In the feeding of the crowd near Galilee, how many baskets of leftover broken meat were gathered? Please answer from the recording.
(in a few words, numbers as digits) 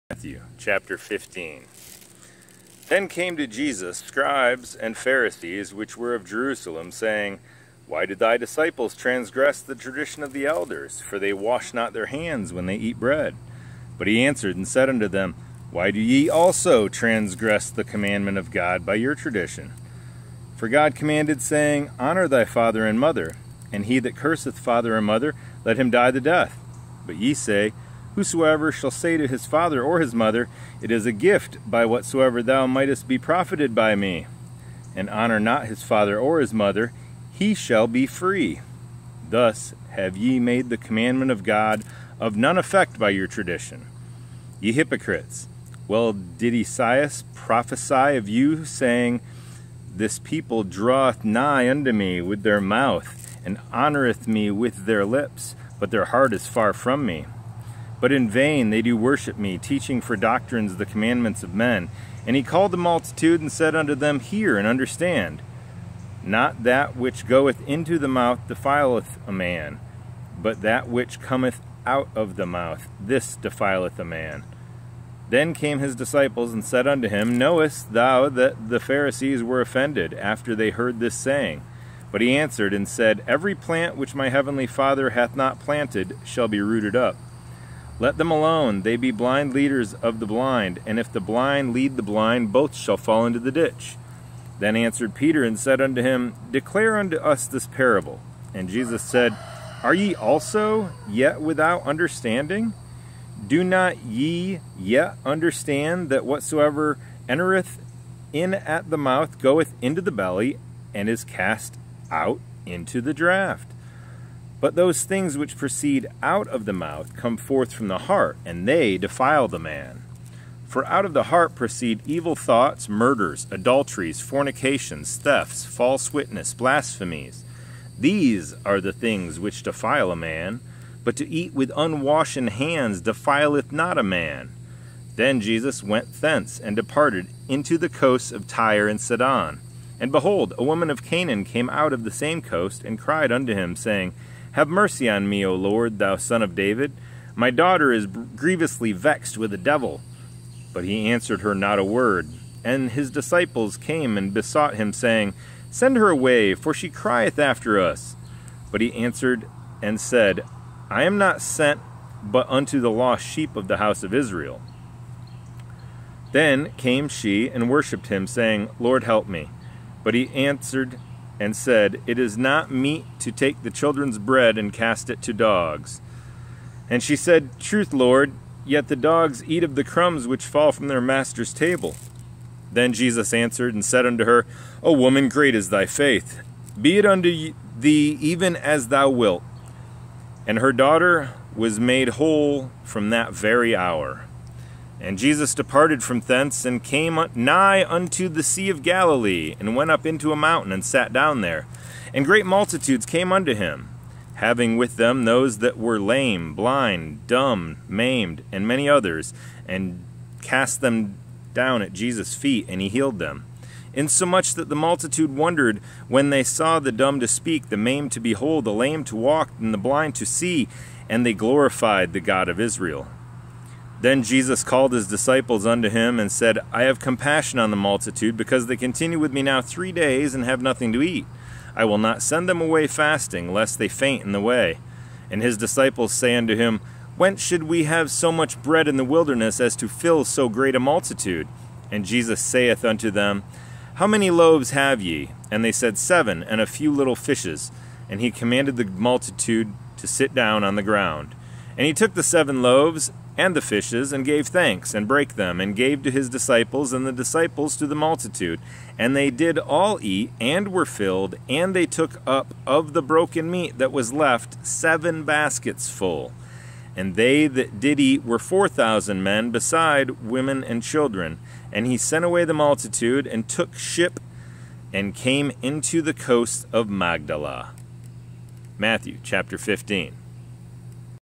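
7 baskets.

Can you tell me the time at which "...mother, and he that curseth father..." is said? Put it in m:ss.
0:22.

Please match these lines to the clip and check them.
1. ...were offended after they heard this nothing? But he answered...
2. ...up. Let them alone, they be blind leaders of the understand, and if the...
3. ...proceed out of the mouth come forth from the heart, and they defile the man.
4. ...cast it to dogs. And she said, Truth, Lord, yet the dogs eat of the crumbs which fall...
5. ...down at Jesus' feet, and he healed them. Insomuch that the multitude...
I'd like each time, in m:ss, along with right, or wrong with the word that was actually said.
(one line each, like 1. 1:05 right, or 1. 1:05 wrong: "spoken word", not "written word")
1. 1:19 wrong: "saying", not "nothing"
2. 1:26 wrong: "blind", not "understand"
3. 1:55 right
4. 2:54 right
5. 3:31 right.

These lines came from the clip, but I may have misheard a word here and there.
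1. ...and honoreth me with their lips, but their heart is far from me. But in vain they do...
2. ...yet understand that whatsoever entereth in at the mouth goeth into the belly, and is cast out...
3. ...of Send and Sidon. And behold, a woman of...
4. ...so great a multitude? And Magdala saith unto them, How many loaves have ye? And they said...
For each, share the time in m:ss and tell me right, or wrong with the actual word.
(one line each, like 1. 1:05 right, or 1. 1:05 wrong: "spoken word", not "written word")
1. 0:53 right
2. 1:44 right
3. 2:18 wrong: "Tyre", not "Send"
4. 4:00 wrong: "Jesus", not "Magdala".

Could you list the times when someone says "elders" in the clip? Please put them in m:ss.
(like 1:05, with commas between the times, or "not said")
0:10.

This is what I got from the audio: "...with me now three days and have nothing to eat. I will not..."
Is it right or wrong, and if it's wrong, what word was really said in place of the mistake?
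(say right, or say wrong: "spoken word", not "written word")
right.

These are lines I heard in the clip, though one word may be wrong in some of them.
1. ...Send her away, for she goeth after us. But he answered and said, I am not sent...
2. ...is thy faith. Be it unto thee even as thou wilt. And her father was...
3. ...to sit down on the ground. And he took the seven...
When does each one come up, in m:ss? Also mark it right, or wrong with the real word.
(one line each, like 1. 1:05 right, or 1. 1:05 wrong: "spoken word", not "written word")
1. 2:35 wrong: "crieth", not "goeth"
2. 3:05 wrong: "daughter", not "father"
3. 4:09 right.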